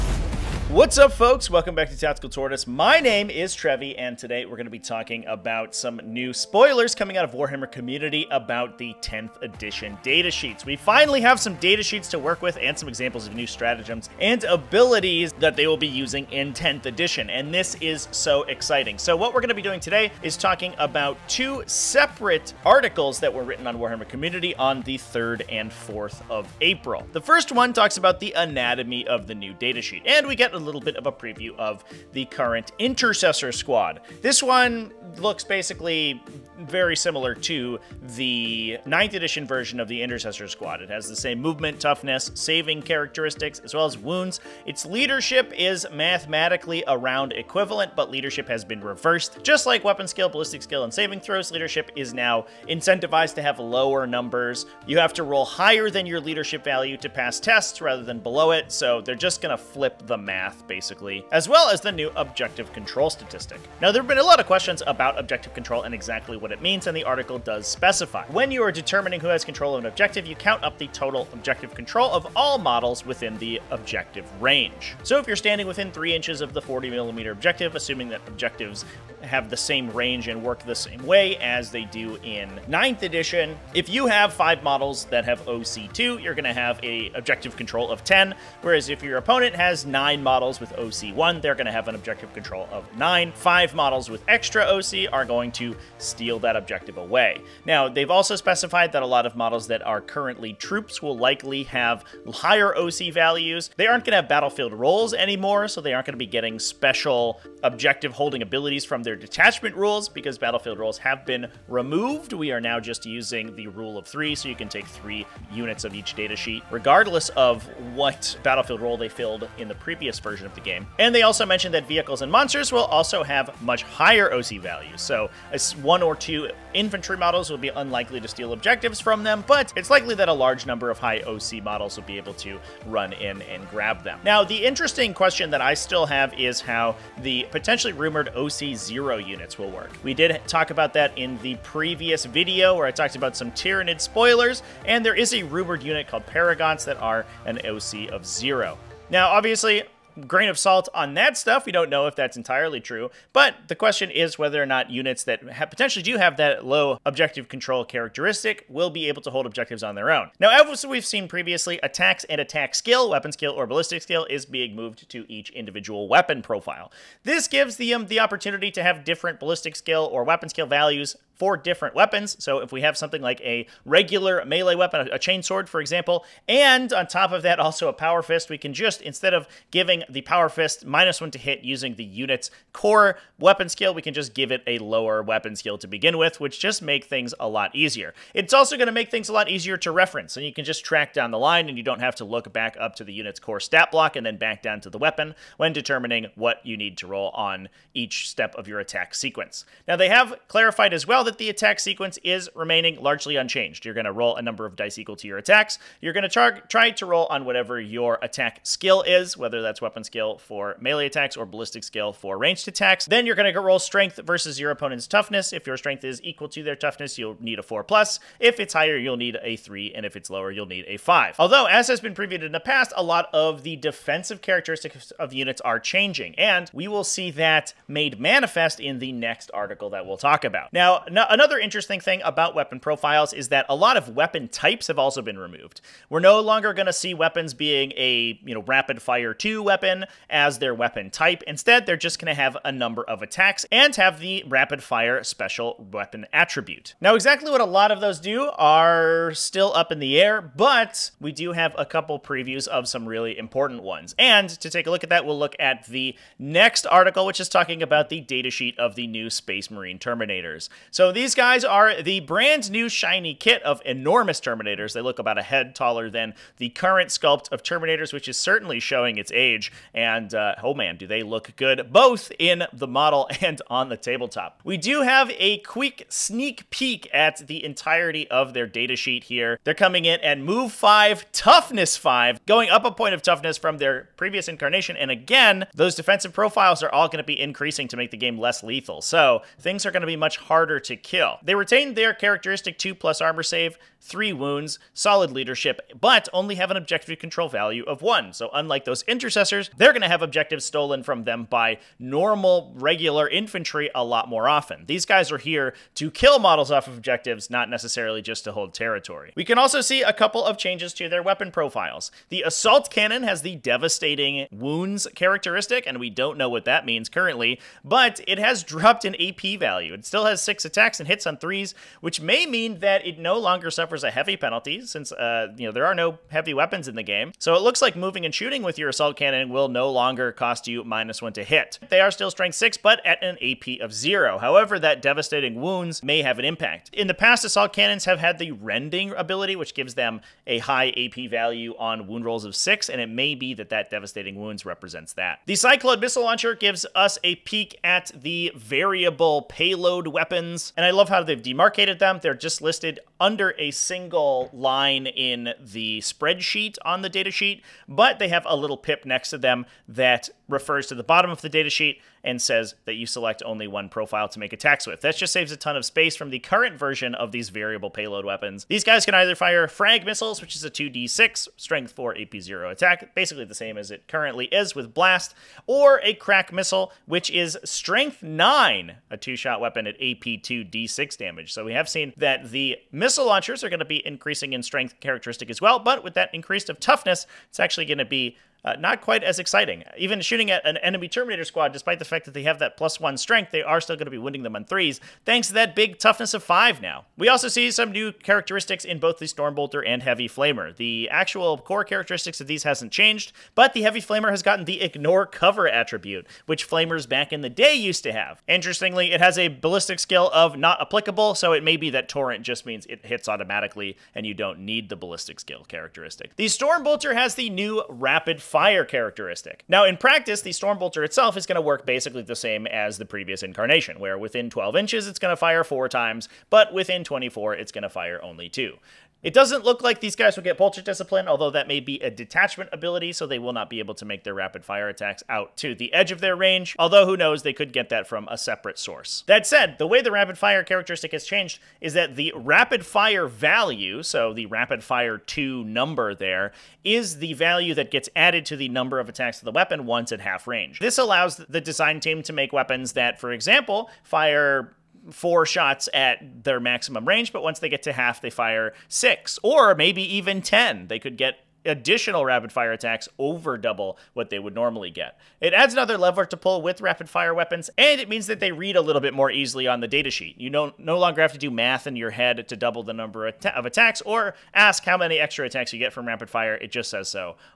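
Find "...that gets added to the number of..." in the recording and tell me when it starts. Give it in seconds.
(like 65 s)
447 s.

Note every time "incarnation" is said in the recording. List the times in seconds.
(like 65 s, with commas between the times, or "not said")
284 s, 423 s.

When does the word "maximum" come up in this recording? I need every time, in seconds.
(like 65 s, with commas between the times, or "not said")
456 s.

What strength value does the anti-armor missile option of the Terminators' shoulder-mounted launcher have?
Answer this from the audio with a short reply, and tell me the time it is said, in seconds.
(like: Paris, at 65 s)
9, at 377 s.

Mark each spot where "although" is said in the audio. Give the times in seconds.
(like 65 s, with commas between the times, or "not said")
221 s, 431 s, 436 s.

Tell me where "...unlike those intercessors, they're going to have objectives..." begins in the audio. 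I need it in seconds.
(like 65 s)
298 s.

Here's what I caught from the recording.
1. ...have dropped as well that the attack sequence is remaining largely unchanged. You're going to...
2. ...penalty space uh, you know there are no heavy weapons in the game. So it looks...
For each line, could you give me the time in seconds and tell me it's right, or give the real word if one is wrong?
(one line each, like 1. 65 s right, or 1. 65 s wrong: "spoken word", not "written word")
1. 200 s wrong: "clarified", not "dropped"
2. 324 s wrong: "since", not "space".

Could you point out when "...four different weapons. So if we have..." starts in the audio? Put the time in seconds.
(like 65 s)
171 s.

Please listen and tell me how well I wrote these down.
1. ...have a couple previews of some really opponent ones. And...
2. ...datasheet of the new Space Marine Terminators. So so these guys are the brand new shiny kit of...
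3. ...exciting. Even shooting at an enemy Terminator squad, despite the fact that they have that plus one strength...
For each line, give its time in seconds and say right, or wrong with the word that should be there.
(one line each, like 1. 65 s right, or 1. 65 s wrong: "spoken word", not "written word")
1. 251 s wrong: "important", not "opponent"
2. 258 s right
3. 389 s right.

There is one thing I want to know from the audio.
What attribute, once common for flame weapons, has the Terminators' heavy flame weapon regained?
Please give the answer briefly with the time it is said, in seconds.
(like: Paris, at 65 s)
Ignore Cover, at 404 s.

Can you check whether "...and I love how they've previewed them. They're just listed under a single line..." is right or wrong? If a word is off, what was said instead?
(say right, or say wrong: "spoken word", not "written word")
wrong: "demarcated", not "previewed".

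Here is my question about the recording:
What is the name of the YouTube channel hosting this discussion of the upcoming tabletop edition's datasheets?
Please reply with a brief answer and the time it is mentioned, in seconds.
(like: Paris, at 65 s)
Tactical Tortoise, at 1 s.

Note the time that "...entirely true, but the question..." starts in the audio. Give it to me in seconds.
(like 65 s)
152 s.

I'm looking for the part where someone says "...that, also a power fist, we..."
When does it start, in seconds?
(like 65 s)
177 s.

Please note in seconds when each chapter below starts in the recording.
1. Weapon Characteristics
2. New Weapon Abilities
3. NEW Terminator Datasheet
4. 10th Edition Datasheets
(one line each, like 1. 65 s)
1. 160 s
2. 442 s
3. 247 s
4. 35 s.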